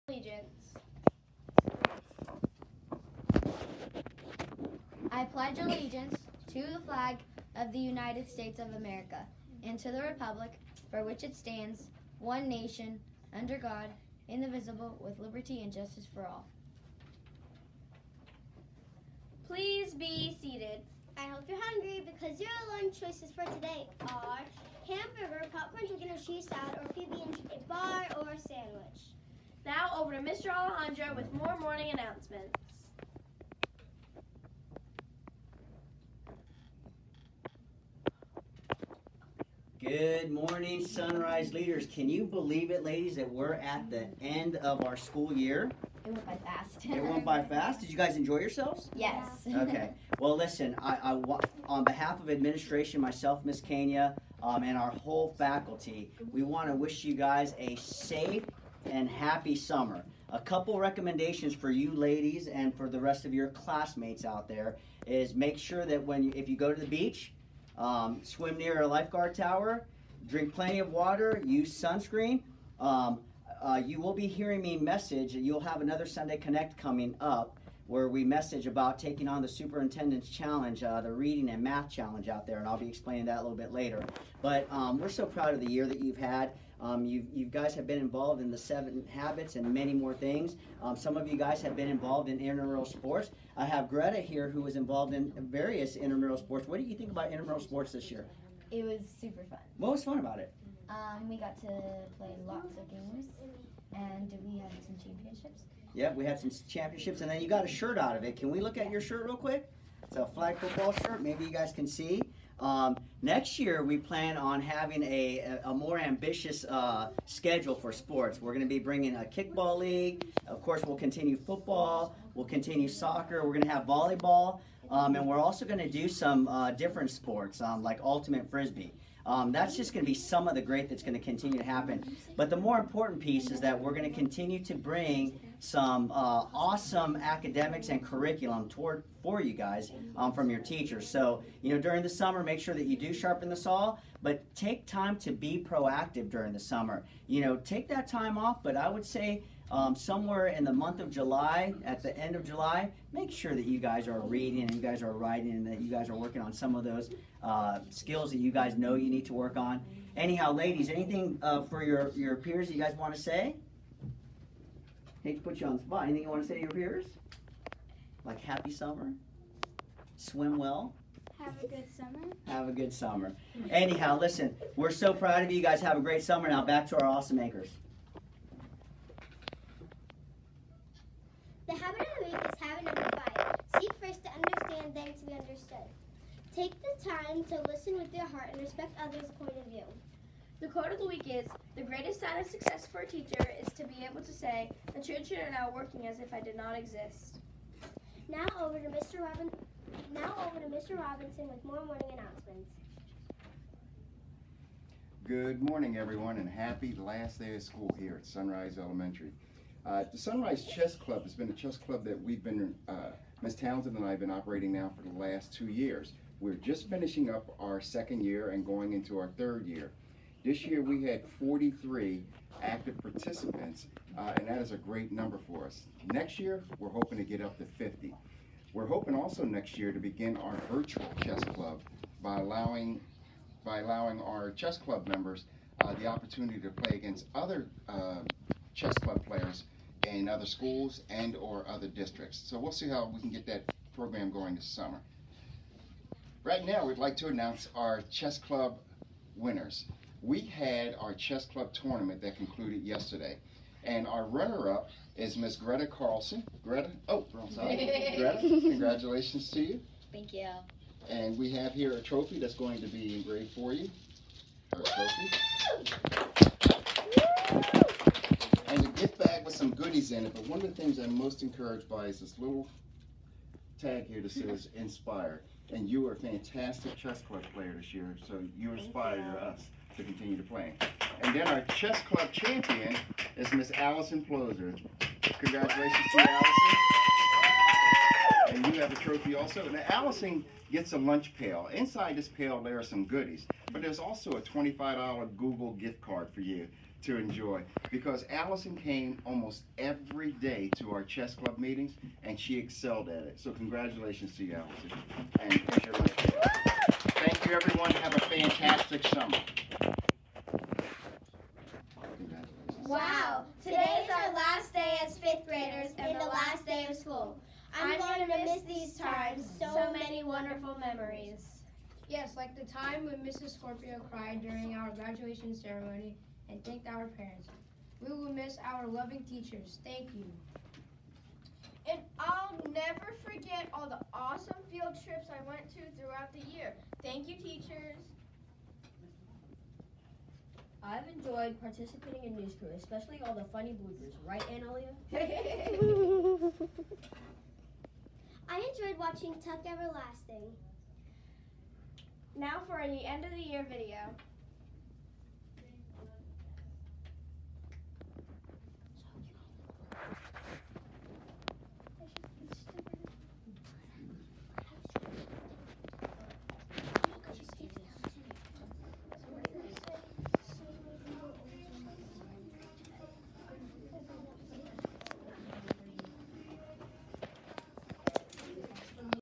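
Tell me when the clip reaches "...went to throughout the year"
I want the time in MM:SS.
05:35.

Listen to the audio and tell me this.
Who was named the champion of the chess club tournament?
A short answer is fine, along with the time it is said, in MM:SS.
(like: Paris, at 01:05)
Allison Ploser, at 04:43.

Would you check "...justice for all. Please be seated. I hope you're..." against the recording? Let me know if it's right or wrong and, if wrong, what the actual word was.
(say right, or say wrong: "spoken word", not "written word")
right.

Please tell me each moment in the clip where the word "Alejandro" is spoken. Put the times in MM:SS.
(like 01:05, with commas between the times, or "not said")
00:30.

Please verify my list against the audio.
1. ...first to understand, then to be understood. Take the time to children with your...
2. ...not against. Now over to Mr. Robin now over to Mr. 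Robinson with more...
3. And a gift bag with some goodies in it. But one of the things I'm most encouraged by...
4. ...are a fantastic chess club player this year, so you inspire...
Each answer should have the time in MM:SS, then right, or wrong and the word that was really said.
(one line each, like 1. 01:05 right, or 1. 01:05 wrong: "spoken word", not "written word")
1. 03:04 wrong: "listen", not "children"
2. 03:16 wrong: "exist", not "against"
3. 04:28 right
4. 04:36 right.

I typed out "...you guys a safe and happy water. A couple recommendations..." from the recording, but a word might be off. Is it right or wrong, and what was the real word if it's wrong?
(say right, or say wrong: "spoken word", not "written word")
wrong: "summer", not "water".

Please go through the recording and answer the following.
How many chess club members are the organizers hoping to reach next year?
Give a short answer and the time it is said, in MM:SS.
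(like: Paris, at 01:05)
50, at 03:47.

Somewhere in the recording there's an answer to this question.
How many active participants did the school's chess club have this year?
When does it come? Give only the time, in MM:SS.
03:41.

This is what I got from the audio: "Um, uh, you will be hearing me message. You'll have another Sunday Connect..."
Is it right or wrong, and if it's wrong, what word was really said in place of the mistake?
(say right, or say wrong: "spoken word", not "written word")
right.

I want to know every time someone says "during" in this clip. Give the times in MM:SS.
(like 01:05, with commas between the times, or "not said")
02:21, 02:26, 05:24.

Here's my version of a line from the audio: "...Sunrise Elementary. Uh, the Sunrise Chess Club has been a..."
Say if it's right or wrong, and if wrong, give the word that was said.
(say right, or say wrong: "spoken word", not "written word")
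right.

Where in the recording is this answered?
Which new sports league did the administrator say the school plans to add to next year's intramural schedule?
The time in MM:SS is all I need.
01:59.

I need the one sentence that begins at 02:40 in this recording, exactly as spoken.
Anyhow, ladies, anything uh, for your, your peers that you guys want to say?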